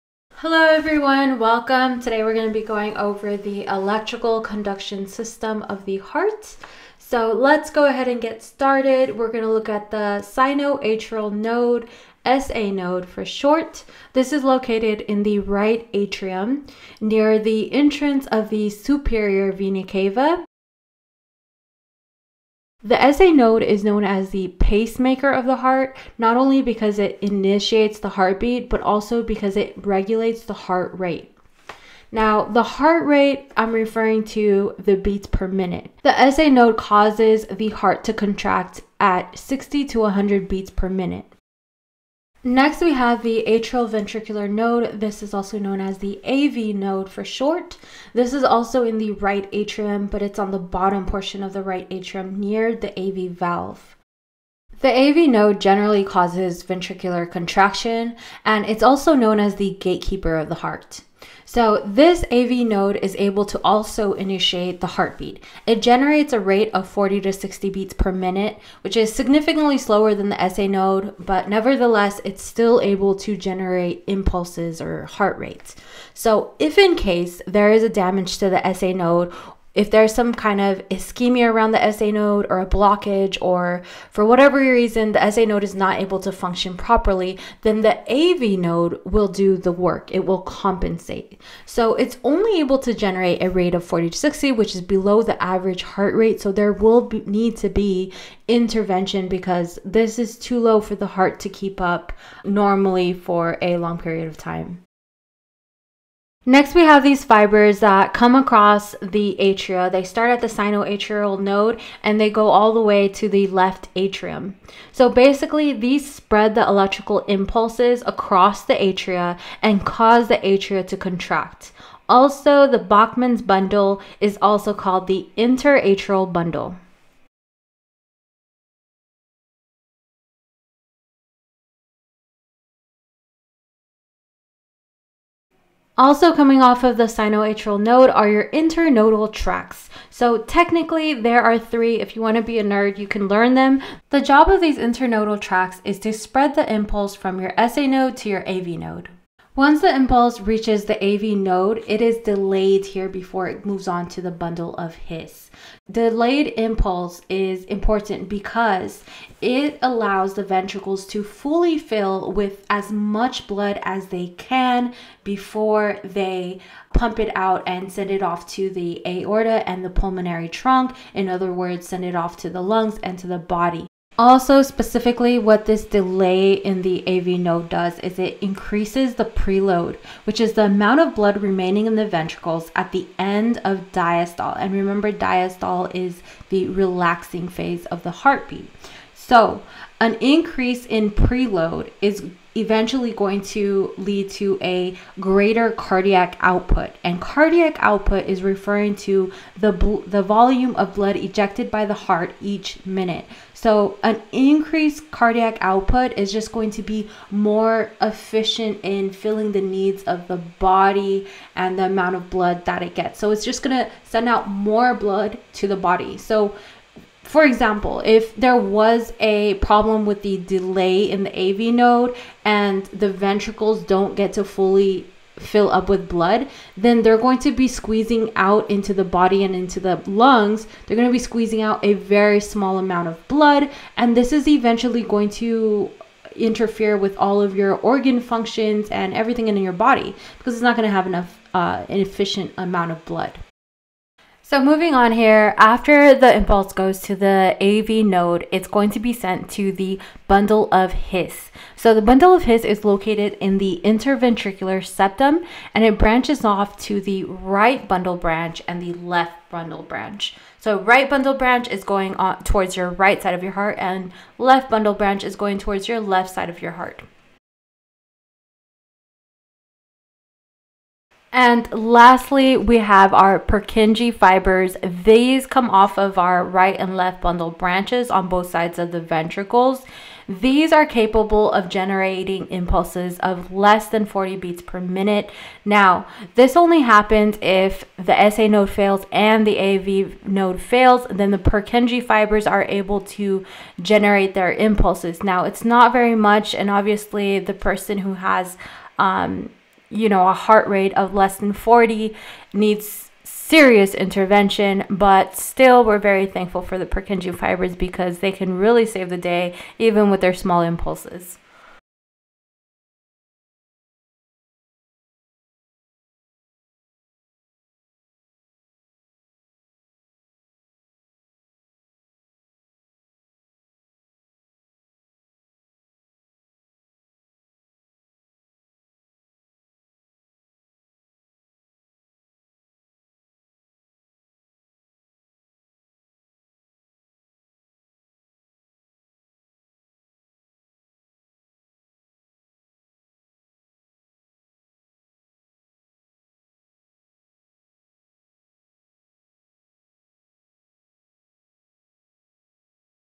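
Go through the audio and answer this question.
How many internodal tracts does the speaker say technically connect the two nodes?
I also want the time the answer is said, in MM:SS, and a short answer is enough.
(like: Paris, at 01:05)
3, at 02:21.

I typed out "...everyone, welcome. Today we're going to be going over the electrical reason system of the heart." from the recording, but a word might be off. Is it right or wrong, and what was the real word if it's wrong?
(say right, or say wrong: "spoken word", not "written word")
wrong: "conduction", not "reason".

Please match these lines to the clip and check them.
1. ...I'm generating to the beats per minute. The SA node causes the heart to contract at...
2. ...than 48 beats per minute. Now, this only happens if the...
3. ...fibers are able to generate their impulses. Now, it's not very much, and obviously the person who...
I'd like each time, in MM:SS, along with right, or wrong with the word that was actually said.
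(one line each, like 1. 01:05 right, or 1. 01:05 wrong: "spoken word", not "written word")
1. 00:33 wrong: "referring", not "generating"
2. 04:43 wrong: "40", not "48"
3. 04:52 right.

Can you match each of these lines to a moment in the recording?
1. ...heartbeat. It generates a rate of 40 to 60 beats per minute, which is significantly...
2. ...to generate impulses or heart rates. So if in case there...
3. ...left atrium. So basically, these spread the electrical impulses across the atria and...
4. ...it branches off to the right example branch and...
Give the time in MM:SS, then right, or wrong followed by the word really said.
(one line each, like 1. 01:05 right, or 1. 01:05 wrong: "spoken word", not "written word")
1. 01:04 right
2. 01:13 right
3. 01:53 right
4. 04:15 wrong: "bundle", not "example".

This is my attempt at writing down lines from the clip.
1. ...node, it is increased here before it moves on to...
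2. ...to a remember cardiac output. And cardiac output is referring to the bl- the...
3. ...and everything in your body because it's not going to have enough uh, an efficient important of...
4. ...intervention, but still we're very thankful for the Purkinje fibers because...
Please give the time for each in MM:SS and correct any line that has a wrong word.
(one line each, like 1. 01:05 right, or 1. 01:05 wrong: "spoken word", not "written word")
1. 02:31 wrong: "delayed", not "increased"
2. 03:14 wrong: "greater", not "remember"
3. 03:58 wrong: "amount", not "important"
4. 05:03 right.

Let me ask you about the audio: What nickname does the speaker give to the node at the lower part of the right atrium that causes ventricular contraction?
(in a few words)
gatekeeper of the heart.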